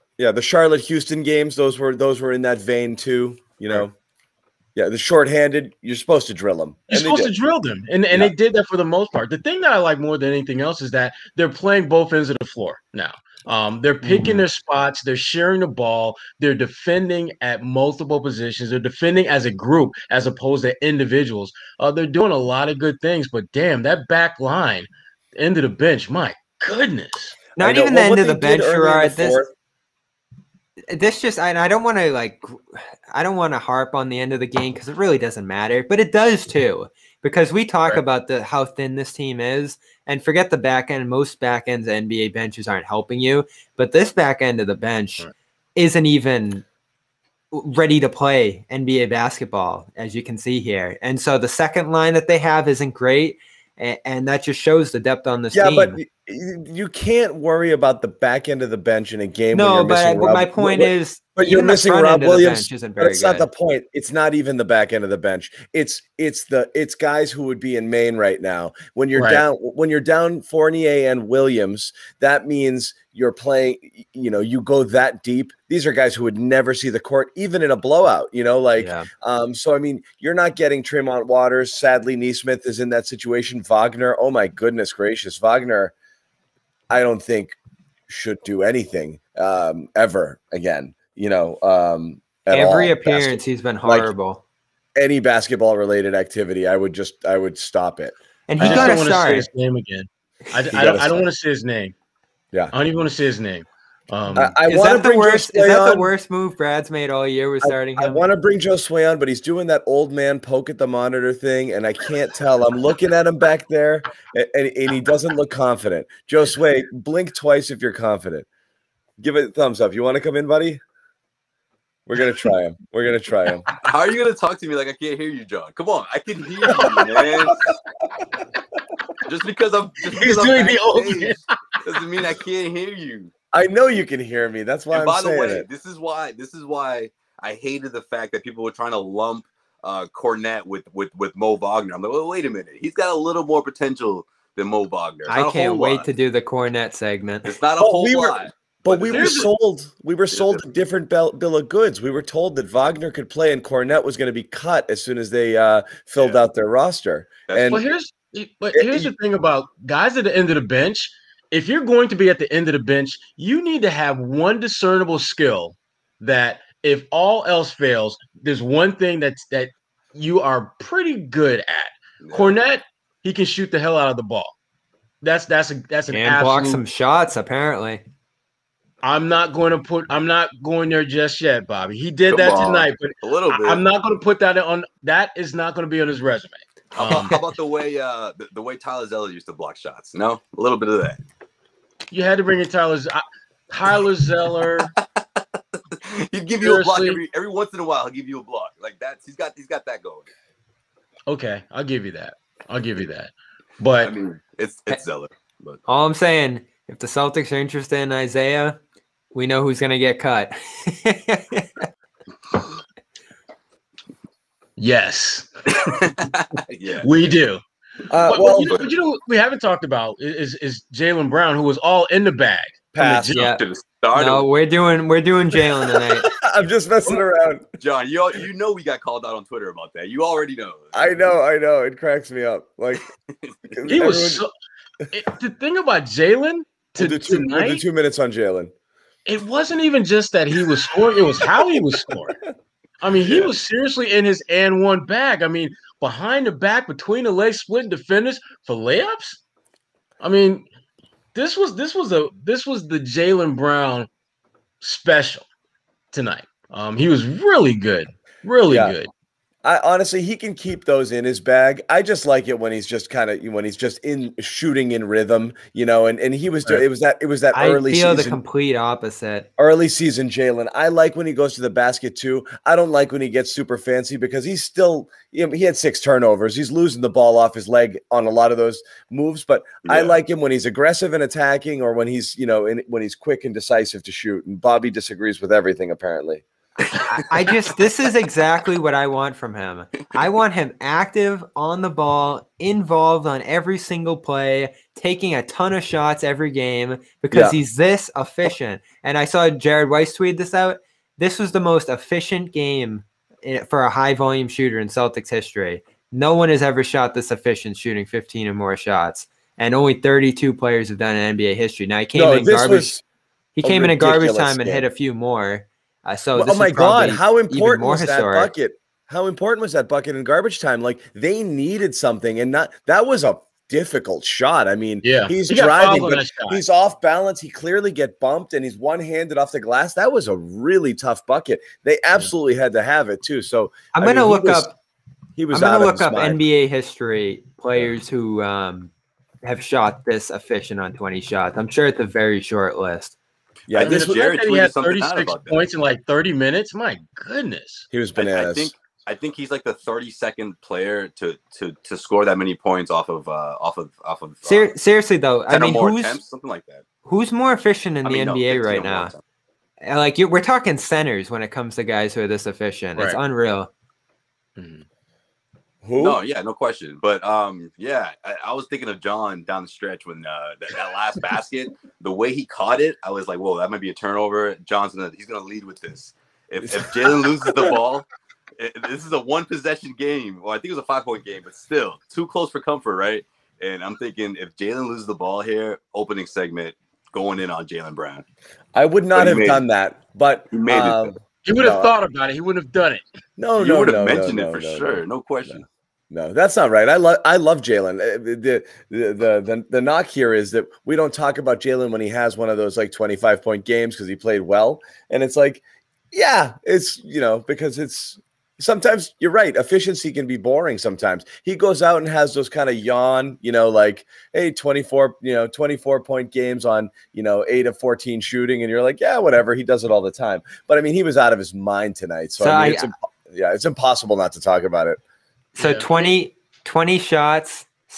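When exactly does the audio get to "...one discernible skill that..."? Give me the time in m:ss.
2:44.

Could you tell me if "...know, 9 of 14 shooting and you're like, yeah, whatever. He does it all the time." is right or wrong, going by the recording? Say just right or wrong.
wrong.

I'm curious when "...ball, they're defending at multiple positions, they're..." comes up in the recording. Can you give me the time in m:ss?
0:15.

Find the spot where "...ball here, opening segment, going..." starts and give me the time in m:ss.
6:25.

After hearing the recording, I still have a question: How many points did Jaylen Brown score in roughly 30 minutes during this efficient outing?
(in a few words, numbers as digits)
36.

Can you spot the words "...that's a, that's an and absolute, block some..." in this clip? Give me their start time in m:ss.
2:55.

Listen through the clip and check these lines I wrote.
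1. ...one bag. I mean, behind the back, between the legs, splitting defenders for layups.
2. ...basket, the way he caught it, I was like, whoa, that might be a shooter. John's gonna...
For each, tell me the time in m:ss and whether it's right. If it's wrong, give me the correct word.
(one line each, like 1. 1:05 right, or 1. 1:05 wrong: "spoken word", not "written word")
1. 4:04 right
2. 6:11 wrong: "turnover", not "shooter".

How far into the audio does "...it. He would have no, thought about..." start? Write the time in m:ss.
6:31.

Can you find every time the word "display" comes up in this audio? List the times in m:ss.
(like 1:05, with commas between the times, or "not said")
not said.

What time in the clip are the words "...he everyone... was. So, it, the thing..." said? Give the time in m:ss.
3:53.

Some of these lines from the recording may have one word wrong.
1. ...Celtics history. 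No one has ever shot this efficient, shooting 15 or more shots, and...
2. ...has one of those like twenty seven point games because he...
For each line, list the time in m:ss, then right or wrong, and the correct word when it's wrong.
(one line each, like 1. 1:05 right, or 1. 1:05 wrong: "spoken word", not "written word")
1. 5:04 right
2. 6:42 wrong: "five", not "seven".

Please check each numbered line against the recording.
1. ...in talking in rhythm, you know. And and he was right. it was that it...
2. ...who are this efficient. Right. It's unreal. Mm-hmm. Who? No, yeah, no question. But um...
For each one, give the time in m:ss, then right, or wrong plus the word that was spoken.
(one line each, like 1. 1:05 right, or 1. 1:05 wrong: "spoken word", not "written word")
1. 4:24 wrong: "shooting", not "talking"
2. 6:02 right.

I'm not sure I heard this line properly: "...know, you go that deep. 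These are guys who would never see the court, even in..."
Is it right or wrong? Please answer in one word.
right.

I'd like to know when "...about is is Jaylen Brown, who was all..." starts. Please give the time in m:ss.
3:39.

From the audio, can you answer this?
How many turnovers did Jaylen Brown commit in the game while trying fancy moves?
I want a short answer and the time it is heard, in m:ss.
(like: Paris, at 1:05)
6, at 4:35.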